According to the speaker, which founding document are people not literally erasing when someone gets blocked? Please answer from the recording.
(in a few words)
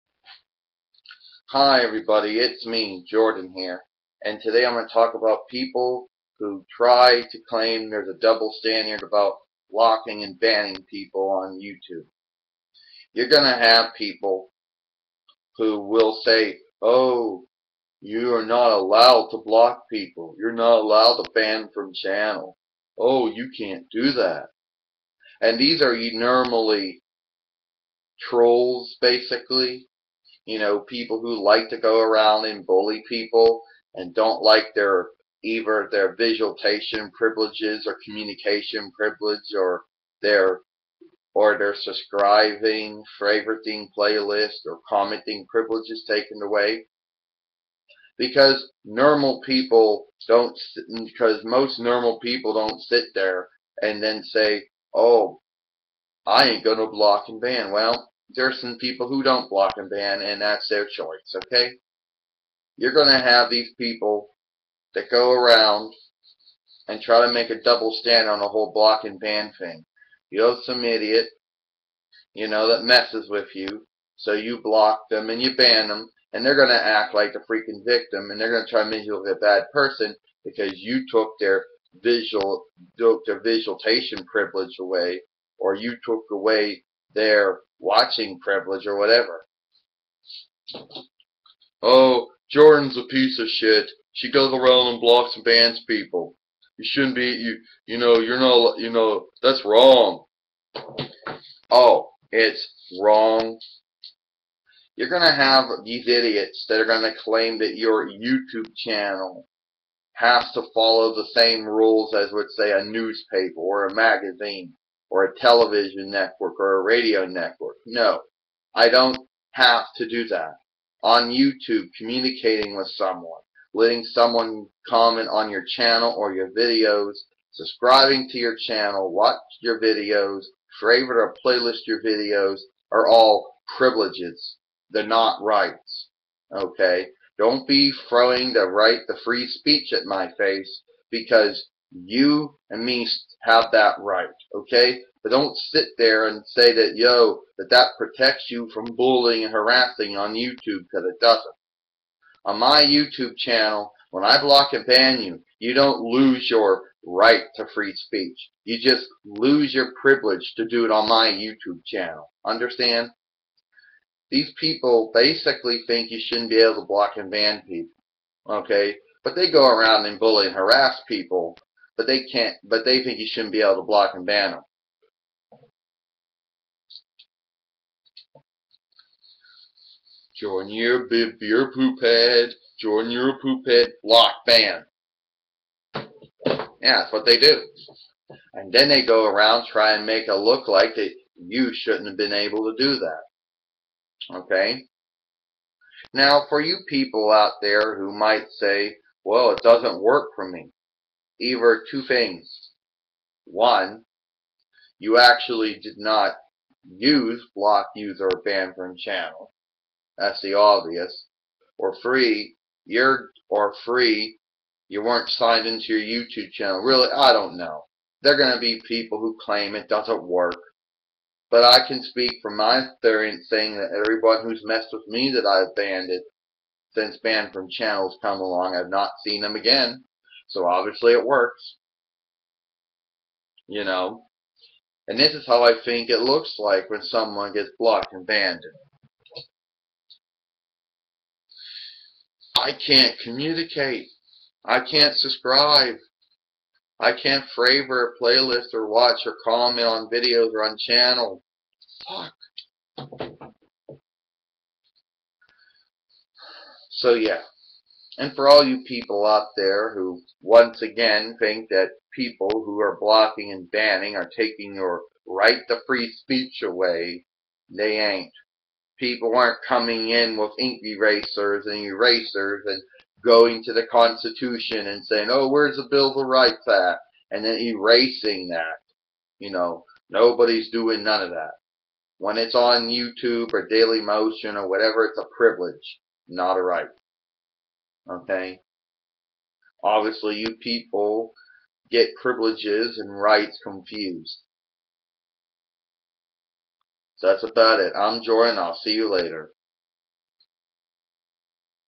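Bill of Rights.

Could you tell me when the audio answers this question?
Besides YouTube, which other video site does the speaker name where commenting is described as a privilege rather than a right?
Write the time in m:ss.
4:43.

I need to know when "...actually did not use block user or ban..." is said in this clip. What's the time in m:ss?
3:25.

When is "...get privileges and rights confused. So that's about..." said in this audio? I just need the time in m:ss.
4:51.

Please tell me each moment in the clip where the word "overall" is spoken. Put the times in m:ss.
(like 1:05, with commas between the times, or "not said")
not said.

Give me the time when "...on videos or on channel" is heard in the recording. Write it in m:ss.
4:09.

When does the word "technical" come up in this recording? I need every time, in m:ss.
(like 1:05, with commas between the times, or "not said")
not said.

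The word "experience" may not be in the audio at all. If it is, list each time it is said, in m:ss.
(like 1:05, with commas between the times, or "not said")
3:42.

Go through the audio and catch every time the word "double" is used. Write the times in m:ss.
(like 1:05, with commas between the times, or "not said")
0:08, 1:07.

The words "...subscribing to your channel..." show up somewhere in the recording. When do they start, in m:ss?
2:07.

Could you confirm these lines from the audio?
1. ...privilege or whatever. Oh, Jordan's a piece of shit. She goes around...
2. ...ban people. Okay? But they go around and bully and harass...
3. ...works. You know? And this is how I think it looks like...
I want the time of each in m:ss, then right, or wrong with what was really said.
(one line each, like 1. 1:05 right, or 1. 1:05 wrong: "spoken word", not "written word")
1. 1:28 right
2. 2:47 right
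3. 3:51 right.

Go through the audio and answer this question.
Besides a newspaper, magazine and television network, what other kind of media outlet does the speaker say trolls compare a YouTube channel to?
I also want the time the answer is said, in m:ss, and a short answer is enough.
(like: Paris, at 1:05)
radio network, at 1:56.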